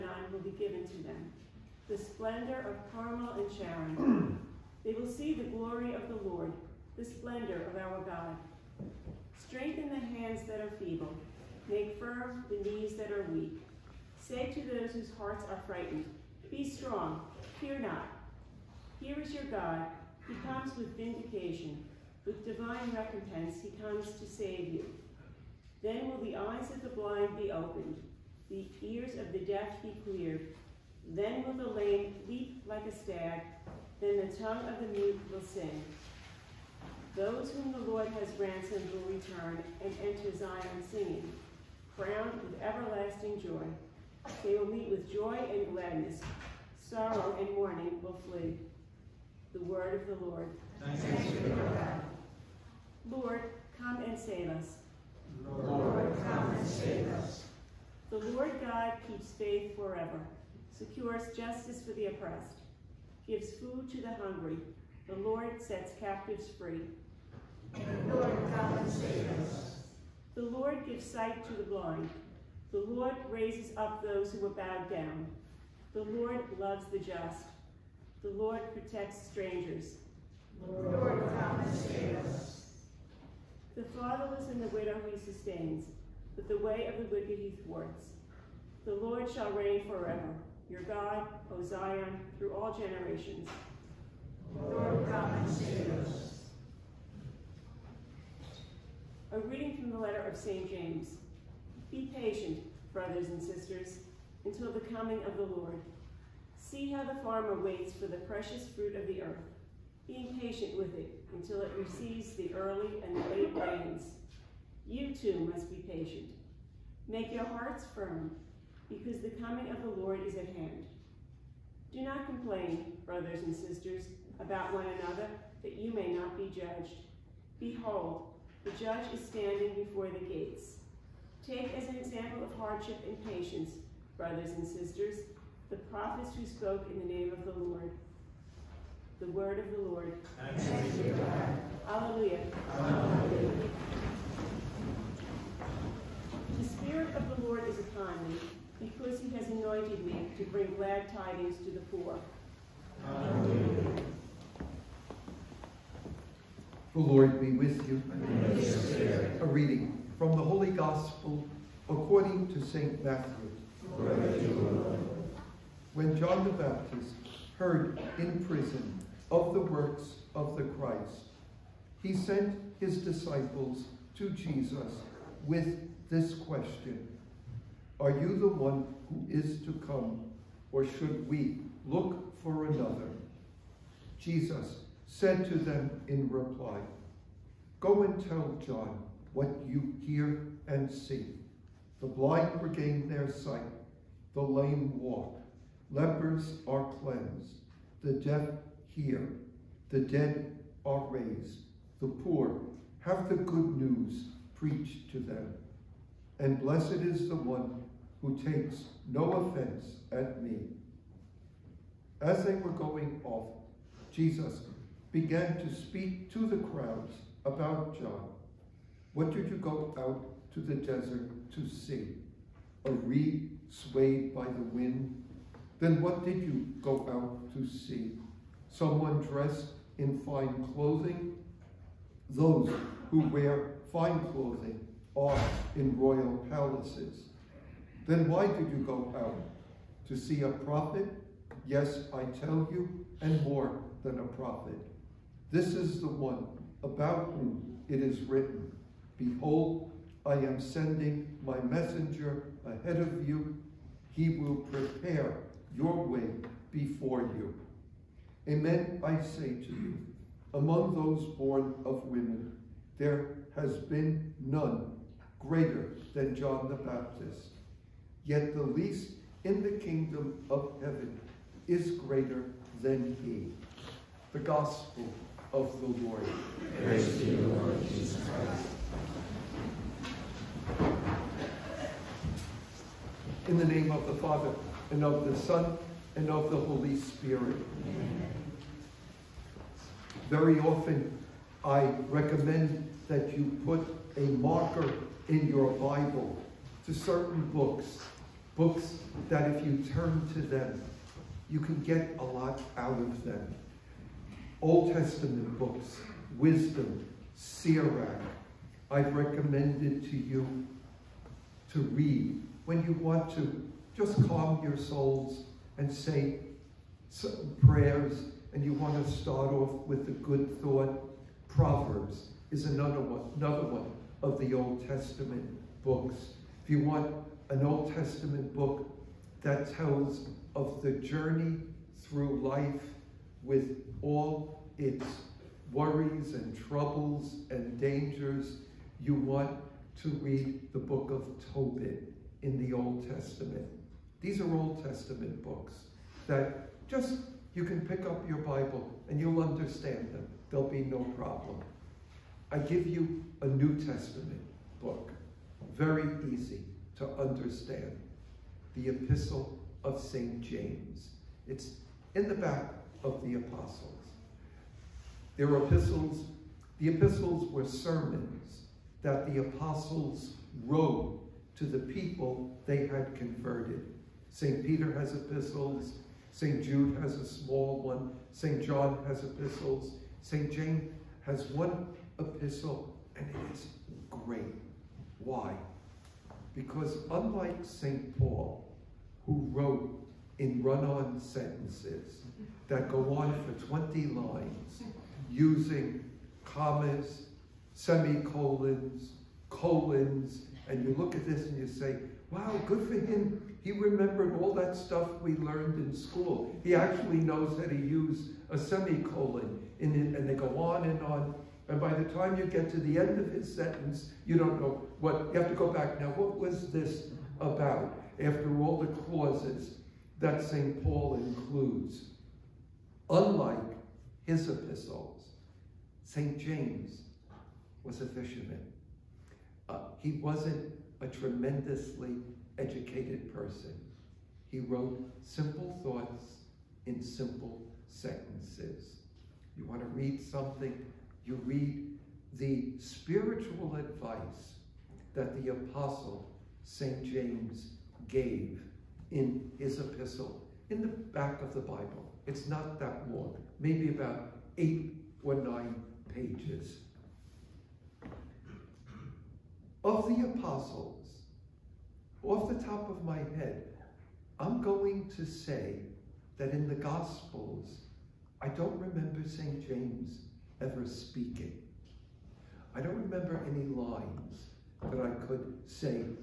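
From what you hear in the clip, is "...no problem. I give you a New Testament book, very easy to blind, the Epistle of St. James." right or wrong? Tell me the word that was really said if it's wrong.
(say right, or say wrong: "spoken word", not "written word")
wrong: "understand", not "blind".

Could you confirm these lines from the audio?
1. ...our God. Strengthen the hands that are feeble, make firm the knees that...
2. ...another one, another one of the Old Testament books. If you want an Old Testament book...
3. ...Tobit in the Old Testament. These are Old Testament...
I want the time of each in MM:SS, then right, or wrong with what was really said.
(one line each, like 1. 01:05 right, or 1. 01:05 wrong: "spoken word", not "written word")
1. 00:07 right
2. 05:22 right
3. 05:41 right.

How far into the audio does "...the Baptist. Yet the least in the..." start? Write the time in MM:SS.
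04:26.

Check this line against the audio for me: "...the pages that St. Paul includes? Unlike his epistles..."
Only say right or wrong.
wrong.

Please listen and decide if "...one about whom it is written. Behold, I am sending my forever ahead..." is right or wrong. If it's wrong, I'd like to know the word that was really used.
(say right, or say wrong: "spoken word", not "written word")
wrong: "messenger", not "forever".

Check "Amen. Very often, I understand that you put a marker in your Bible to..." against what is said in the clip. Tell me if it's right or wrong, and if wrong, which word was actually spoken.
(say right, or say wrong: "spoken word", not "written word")
wrong: "recommend", not "understand".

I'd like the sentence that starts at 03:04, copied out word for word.
Jesus said to them in reply, Go and tell John what you hear and see.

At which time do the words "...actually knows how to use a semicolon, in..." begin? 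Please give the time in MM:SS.
06:46.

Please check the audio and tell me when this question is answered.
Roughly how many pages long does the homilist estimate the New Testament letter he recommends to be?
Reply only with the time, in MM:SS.
07:34.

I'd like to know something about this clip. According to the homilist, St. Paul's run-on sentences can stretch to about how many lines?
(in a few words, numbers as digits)
20.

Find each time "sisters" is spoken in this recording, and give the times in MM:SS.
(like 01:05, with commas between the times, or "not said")
01:43, 02:03, 02:14.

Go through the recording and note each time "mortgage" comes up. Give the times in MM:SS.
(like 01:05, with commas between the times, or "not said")
not said.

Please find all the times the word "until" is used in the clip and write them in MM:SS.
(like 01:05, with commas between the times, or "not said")
01:44, 01:51.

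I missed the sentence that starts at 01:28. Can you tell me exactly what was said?
The Lord shall reign forever, your God, O Zion, through all generations.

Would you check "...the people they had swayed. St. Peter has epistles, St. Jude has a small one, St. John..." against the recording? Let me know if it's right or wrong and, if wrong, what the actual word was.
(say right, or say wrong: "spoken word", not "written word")
wrong: "converted", not "swayed".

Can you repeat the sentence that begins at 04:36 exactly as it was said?
Praise to you, Lord Jesus Christ.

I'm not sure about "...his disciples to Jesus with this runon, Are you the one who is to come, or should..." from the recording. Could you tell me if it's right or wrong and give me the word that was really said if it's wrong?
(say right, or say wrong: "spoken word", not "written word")
wrong: "question", not "runon".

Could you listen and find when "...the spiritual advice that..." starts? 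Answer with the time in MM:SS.
07:22.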